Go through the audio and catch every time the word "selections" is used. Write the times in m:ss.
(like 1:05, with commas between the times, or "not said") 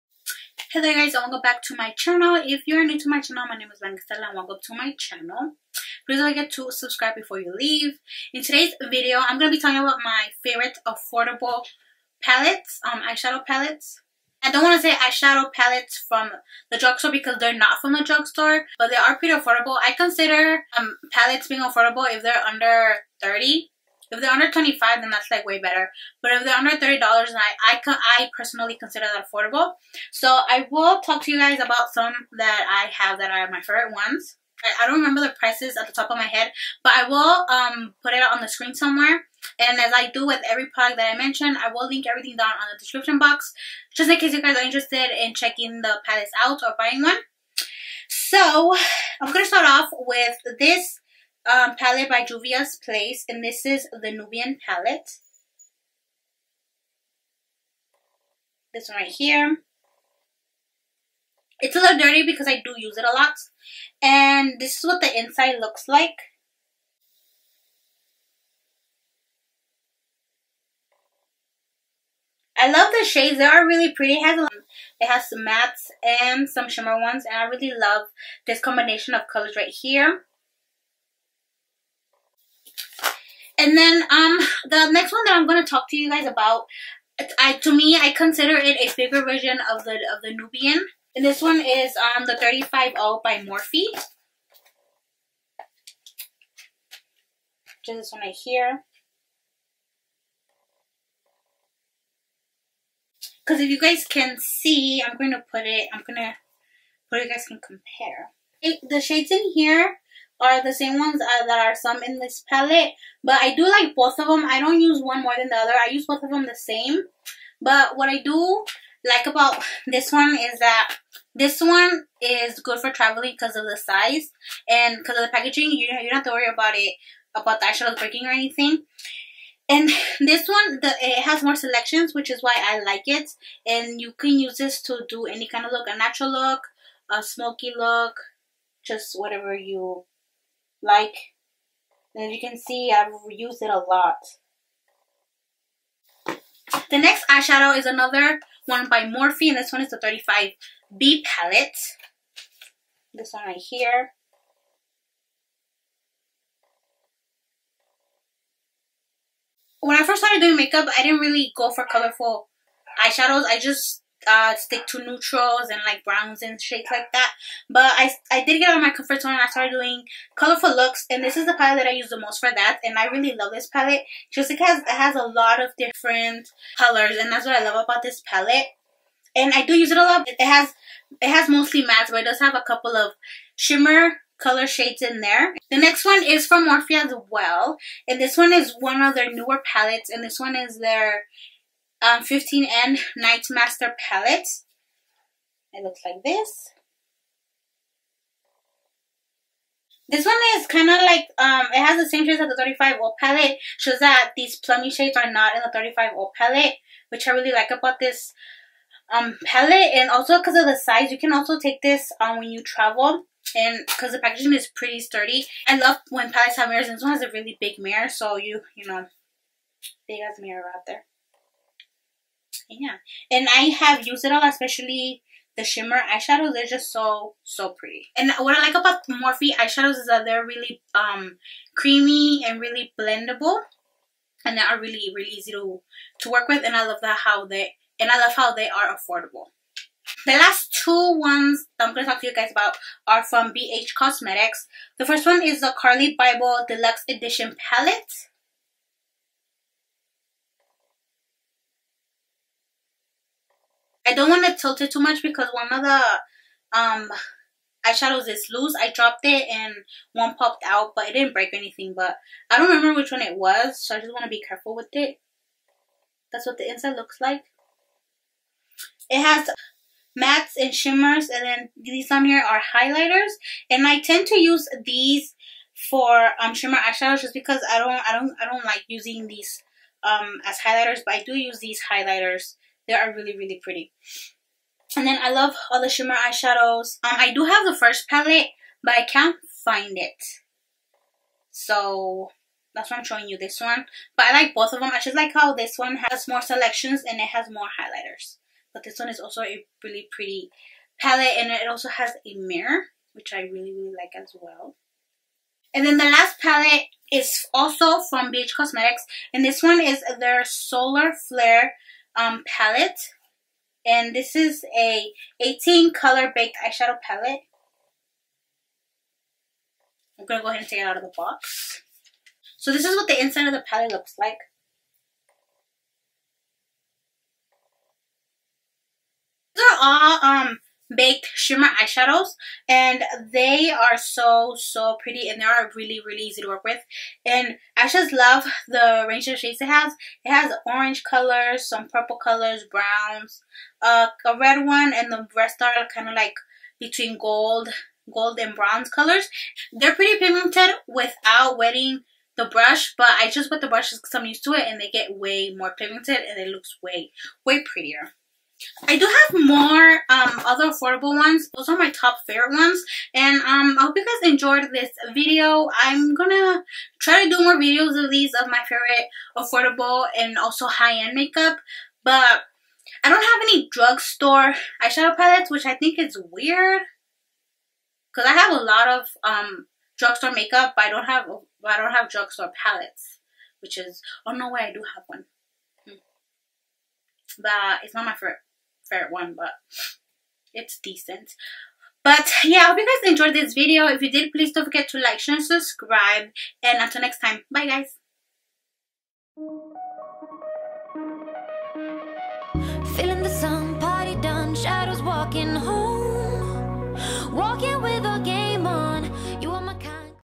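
2:11, 4:56.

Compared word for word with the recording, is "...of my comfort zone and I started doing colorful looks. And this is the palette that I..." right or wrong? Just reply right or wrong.
right.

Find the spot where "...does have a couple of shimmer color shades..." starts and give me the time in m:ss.
3:02.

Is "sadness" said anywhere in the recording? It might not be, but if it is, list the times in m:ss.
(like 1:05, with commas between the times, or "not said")
not said.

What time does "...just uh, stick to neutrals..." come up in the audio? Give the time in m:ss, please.
2:43.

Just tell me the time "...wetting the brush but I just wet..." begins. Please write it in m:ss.
5:51.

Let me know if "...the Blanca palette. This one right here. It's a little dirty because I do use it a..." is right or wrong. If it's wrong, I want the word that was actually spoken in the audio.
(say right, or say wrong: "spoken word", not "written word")
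wrong: "Nubian", not "Blanca".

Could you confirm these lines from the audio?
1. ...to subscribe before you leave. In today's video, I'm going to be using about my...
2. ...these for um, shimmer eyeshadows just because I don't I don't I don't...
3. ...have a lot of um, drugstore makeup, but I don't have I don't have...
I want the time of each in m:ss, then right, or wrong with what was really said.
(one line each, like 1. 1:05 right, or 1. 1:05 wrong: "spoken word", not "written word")
1. 0:06 wrong: "talking", not "using"
2. 4:34 right
3. 6:18 right.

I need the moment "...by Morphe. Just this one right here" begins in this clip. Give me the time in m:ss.
1:33.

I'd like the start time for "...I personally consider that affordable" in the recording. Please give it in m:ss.
0:28.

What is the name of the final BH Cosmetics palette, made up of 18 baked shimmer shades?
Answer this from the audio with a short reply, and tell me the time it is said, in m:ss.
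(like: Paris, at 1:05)
Solar Flare, at 5:10.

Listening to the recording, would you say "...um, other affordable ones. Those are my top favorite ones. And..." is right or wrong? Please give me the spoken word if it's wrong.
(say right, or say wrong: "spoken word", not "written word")
right.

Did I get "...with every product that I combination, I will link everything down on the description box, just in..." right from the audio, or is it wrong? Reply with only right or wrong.
wrong.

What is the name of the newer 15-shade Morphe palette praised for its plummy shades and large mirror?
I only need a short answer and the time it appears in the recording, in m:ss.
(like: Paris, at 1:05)
Nightmaster, at 3:13.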